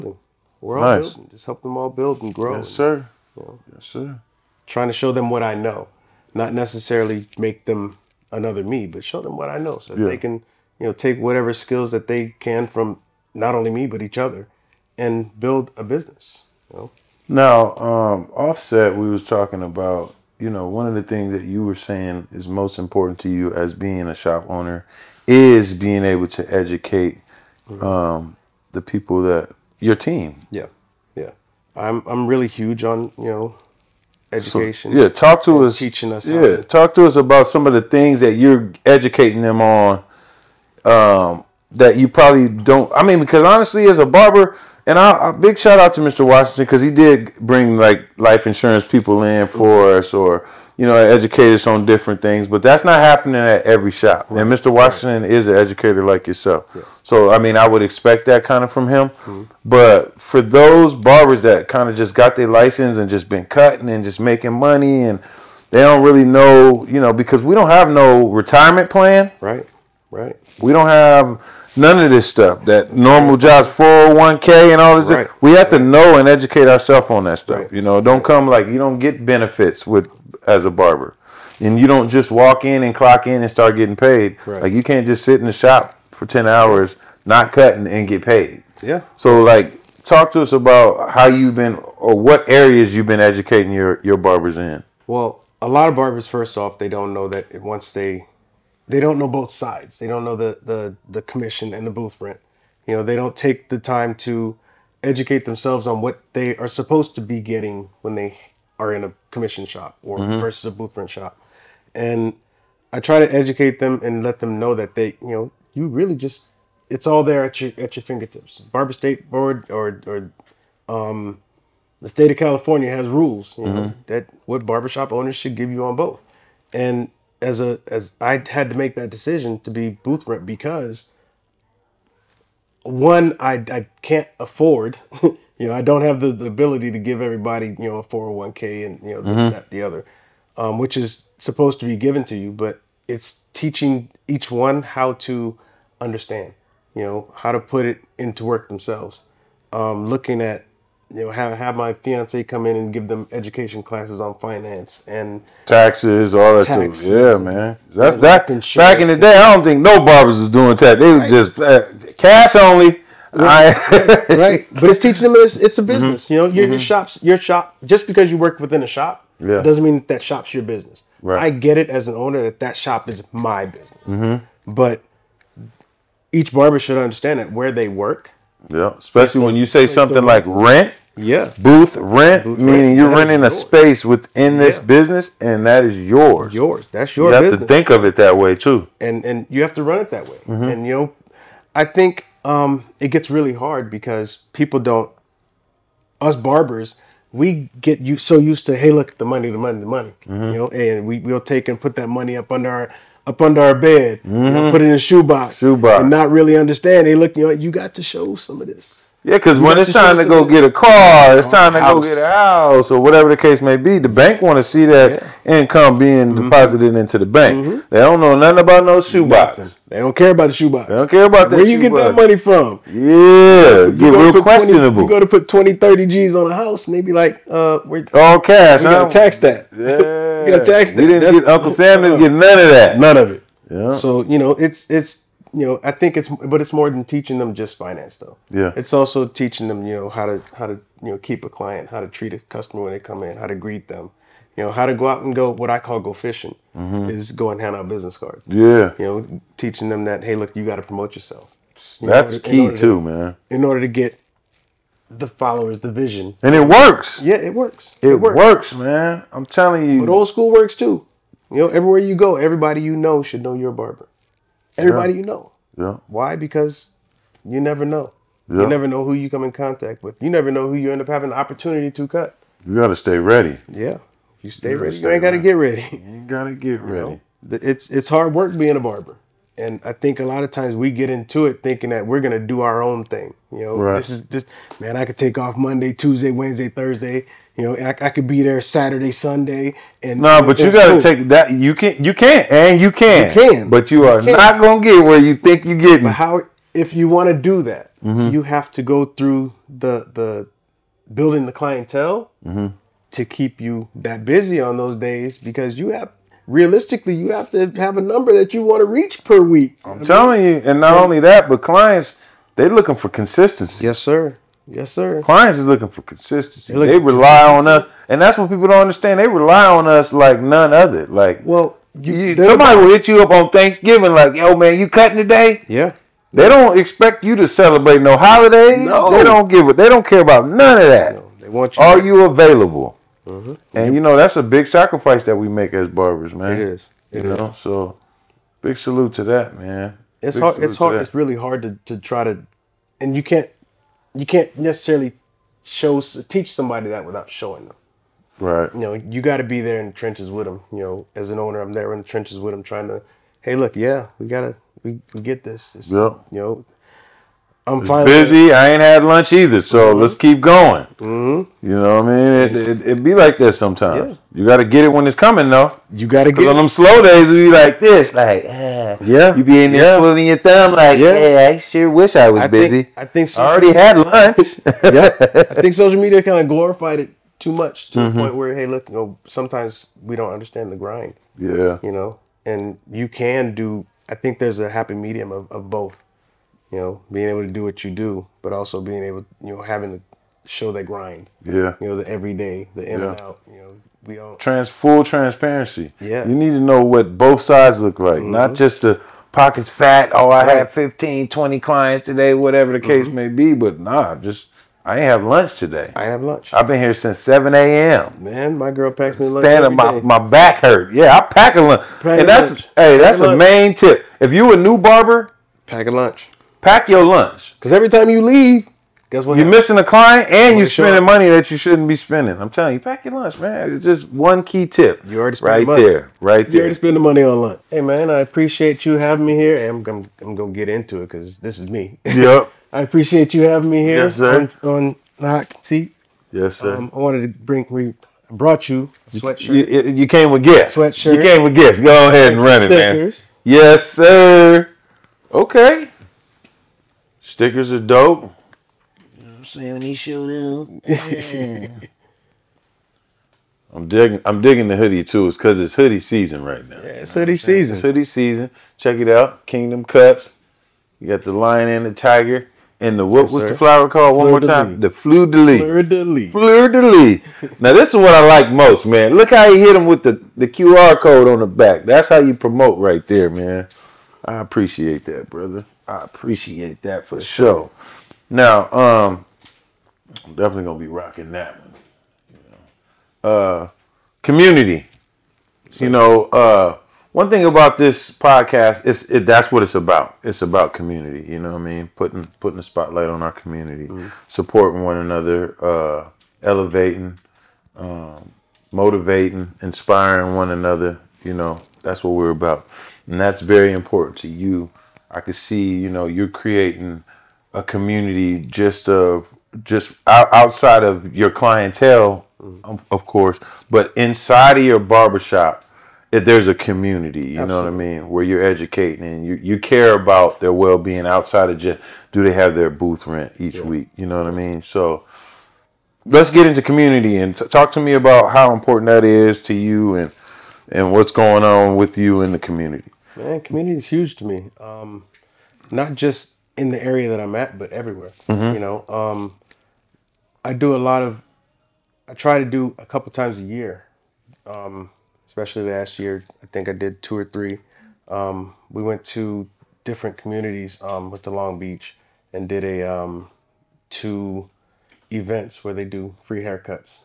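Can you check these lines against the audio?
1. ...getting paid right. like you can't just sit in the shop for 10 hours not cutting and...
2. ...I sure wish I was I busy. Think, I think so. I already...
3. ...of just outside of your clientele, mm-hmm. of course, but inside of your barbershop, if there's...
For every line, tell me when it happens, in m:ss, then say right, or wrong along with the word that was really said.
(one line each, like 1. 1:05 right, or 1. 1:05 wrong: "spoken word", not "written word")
1. 1:23 right
2. 6:11 right
3. 8:28 right.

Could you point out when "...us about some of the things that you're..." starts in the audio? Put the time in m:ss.
0:37.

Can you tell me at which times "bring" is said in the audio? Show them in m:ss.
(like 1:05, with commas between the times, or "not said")
0:47, 7:17.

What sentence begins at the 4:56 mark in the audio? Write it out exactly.
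But how, if you want to do that, mm-hmm.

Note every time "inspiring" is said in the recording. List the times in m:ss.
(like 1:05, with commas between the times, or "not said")
8:19.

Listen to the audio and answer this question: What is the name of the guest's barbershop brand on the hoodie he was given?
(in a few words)
Kingdom Kutz.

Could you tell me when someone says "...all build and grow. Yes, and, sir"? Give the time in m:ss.
0:01.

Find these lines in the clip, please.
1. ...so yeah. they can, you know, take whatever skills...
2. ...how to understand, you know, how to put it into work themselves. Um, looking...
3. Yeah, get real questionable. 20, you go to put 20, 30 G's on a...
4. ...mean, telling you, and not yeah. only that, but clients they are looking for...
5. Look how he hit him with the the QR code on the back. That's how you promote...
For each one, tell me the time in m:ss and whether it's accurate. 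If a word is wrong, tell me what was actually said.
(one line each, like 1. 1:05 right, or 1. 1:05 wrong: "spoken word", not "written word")
1. 0:09 right
2. 2:24 right
3. 3:42 right
4. 5:09 right
5. 7:49 right.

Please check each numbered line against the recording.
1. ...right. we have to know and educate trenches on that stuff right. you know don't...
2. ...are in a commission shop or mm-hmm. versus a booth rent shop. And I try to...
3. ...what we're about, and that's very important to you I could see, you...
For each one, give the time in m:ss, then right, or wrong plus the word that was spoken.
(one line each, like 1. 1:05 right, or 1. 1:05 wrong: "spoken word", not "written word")
1. 1:15 wrong: "ourselves", not "trenches"
2. 1:48 right
3. 8:22 right.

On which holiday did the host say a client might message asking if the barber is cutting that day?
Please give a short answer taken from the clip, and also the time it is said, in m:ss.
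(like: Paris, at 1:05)
Thanksgiving, at 5:23.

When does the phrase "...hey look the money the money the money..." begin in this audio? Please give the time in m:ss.
3:18.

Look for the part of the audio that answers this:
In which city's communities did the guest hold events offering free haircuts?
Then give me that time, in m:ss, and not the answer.
9:11.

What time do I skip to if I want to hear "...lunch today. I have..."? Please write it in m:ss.
6:45.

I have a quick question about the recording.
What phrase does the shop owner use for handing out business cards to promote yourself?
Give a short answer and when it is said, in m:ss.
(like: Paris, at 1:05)
Go fishing, at 4:05.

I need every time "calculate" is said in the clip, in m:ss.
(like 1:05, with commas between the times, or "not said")
not said.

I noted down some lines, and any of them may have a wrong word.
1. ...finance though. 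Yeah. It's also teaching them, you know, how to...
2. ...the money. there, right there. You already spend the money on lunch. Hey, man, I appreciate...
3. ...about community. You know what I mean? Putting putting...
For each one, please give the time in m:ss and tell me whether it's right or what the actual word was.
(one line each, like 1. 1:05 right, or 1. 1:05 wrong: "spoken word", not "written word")
1. 3:57 right
2. 7:05 right
3. 8:10 right.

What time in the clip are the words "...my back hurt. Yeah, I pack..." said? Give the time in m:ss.
6:49.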